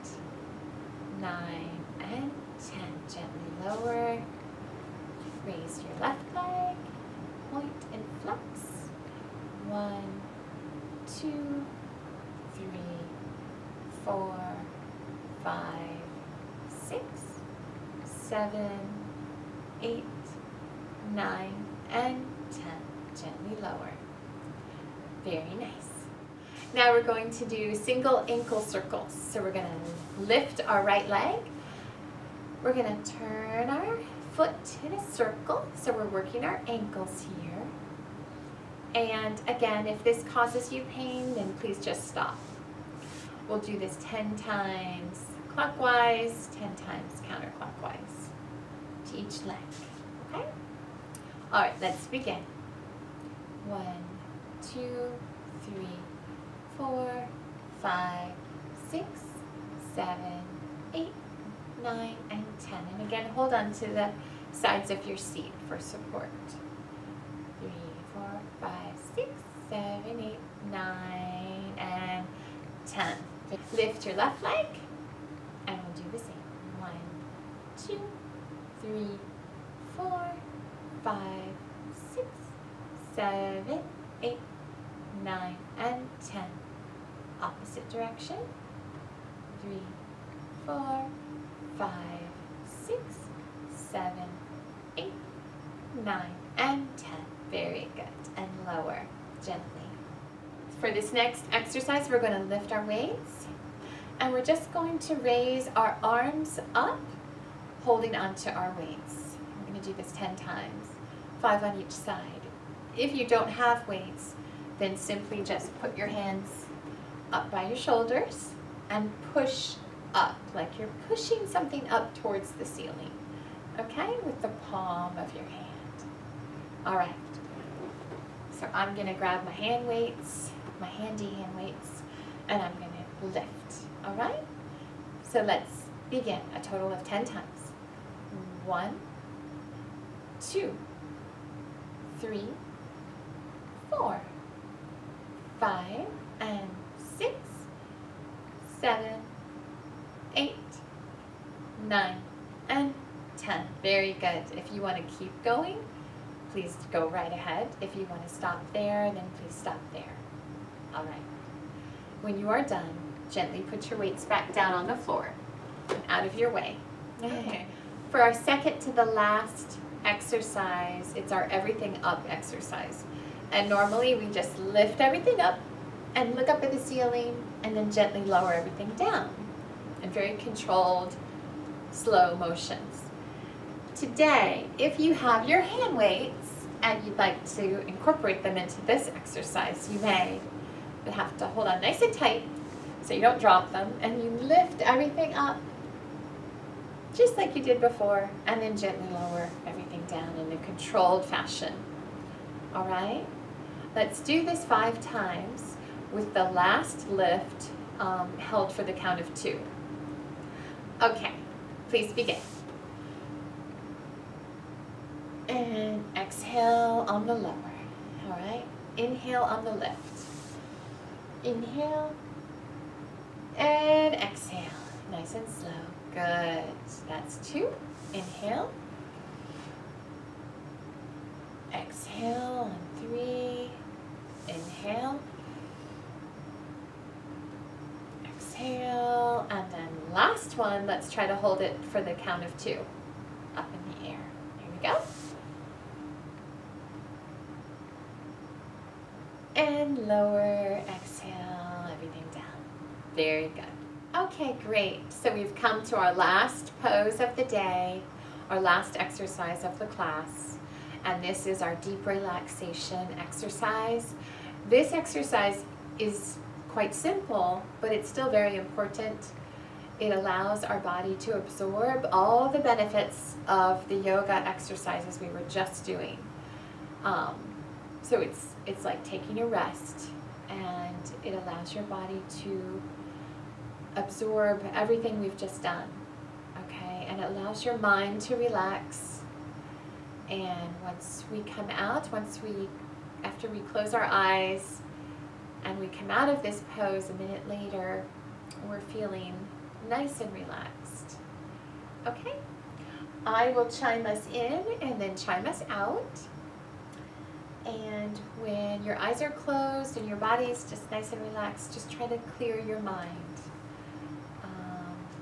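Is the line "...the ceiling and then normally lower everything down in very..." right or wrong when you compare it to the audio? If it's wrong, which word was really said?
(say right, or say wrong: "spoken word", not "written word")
wrong: "gently", not "normally".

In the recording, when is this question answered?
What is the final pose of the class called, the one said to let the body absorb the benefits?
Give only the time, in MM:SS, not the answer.
04:21.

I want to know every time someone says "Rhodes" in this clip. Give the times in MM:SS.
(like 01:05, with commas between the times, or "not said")
not said.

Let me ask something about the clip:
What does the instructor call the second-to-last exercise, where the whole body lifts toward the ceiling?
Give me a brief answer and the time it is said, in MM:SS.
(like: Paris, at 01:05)
everything up exercise, at 02:51.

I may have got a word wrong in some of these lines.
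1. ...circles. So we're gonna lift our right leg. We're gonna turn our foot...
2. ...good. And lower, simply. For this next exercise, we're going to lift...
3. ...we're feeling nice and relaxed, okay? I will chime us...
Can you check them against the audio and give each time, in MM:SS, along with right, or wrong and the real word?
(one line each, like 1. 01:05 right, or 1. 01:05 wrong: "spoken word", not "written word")
1. 00:28 right
2. 01:37 wrong: "gently", not "simply"
3. 04:58 right.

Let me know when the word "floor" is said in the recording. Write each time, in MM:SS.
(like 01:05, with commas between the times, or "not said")
02:44.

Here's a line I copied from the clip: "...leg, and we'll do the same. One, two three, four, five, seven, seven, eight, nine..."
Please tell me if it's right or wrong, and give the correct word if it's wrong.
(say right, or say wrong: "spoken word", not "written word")
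wrong: "six", not "seven".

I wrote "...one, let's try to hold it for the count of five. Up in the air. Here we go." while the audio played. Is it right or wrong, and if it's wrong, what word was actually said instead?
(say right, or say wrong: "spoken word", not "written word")
wrong: "two", not "five".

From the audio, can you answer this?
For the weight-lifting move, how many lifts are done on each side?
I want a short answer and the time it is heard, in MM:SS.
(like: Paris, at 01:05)
5, at 01:51.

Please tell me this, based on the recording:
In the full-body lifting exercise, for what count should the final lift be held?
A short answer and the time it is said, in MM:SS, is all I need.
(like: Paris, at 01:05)
2, at 03:28.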